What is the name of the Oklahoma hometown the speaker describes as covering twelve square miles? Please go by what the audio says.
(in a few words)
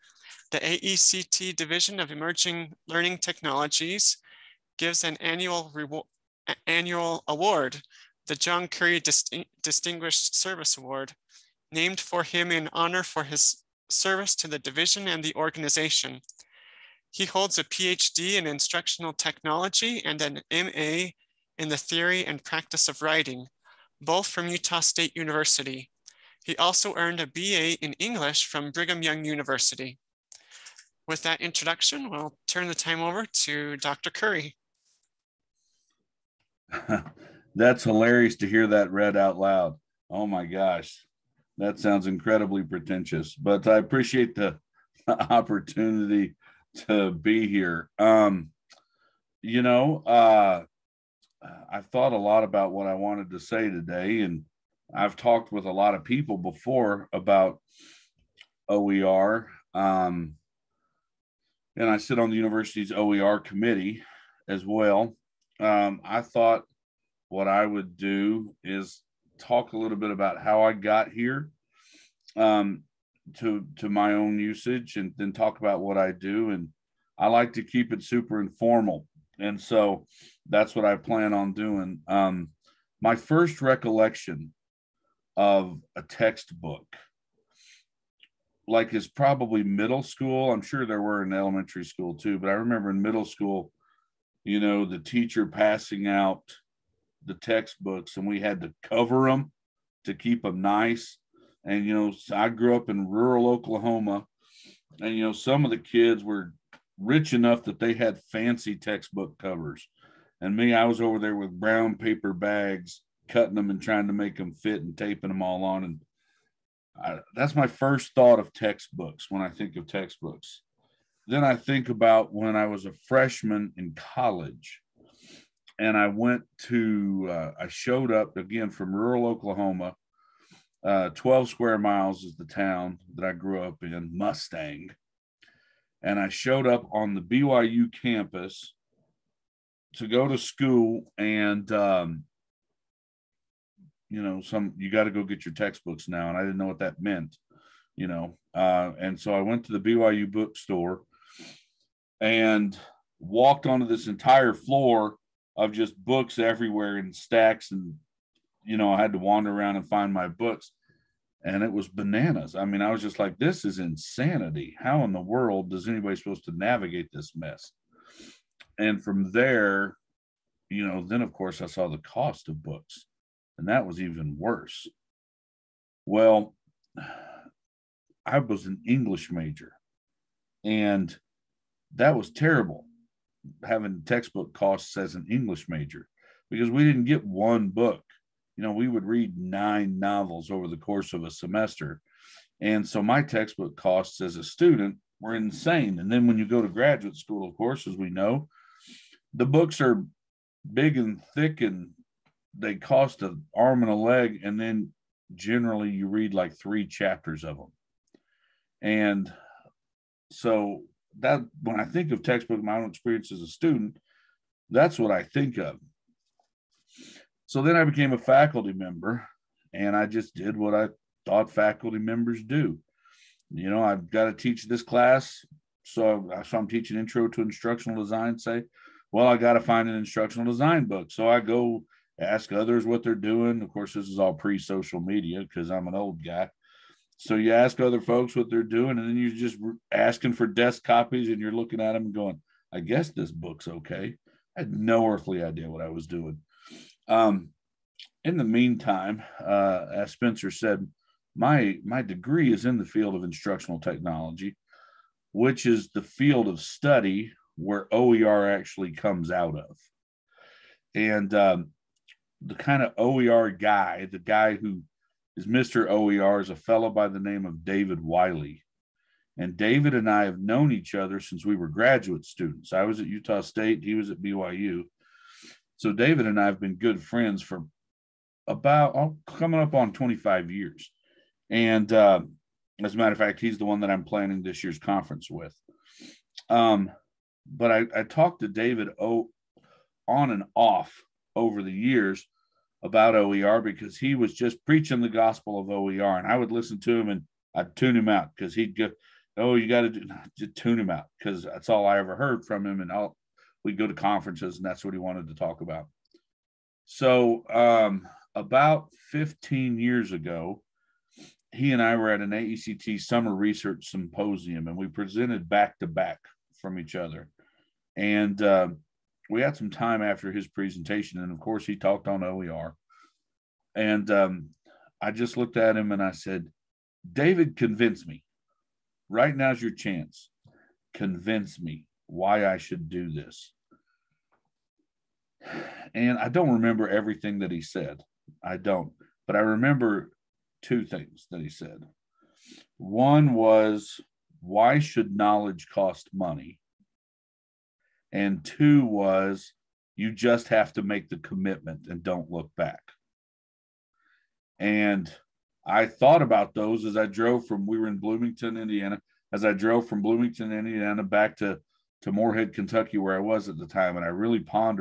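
Mustang.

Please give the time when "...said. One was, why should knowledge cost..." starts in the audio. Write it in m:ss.
5:41.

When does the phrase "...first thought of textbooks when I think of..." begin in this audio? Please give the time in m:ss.
1:57.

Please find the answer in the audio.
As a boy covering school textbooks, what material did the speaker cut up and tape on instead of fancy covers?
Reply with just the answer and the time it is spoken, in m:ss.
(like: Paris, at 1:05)
brown paper bags, at 1:51.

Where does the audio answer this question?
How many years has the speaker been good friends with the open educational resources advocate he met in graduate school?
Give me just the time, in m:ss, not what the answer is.
4:39.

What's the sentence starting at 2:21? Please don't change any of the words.
And, um, you know, some, you got to go get your textbooks now.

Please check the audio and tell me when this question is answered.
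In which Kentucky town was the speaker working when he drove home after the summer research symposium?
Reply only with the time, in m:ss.
6:02.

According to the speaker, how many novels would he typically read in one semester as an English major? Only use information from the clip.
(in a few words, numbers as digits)
9.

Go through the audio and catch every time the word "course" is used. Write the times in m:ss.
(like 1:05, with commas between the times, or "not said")
2:51, 3:10, 3:17, 3:53, 5:21.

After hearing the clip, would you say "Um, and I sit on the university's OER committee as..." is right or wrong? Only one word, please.
right.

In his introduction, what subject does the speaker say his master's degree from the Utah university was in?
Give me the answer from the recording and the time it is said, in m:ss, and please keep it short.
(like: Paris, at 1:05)
theory and practice of writing, at 0:21.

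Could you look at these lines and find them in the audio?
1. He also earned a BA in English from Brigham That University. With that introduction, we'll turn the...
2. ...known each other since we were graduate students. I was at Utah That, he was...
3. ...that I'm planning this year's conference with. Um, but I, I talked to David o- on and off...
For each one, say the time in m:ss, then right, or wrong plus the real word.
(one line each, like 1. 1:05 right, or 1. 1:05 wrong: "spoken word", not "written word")
1. 0:26 wrong: "Young", not "That"
2. 4:30 wrong: "State", not "That"
3. 4:43 right.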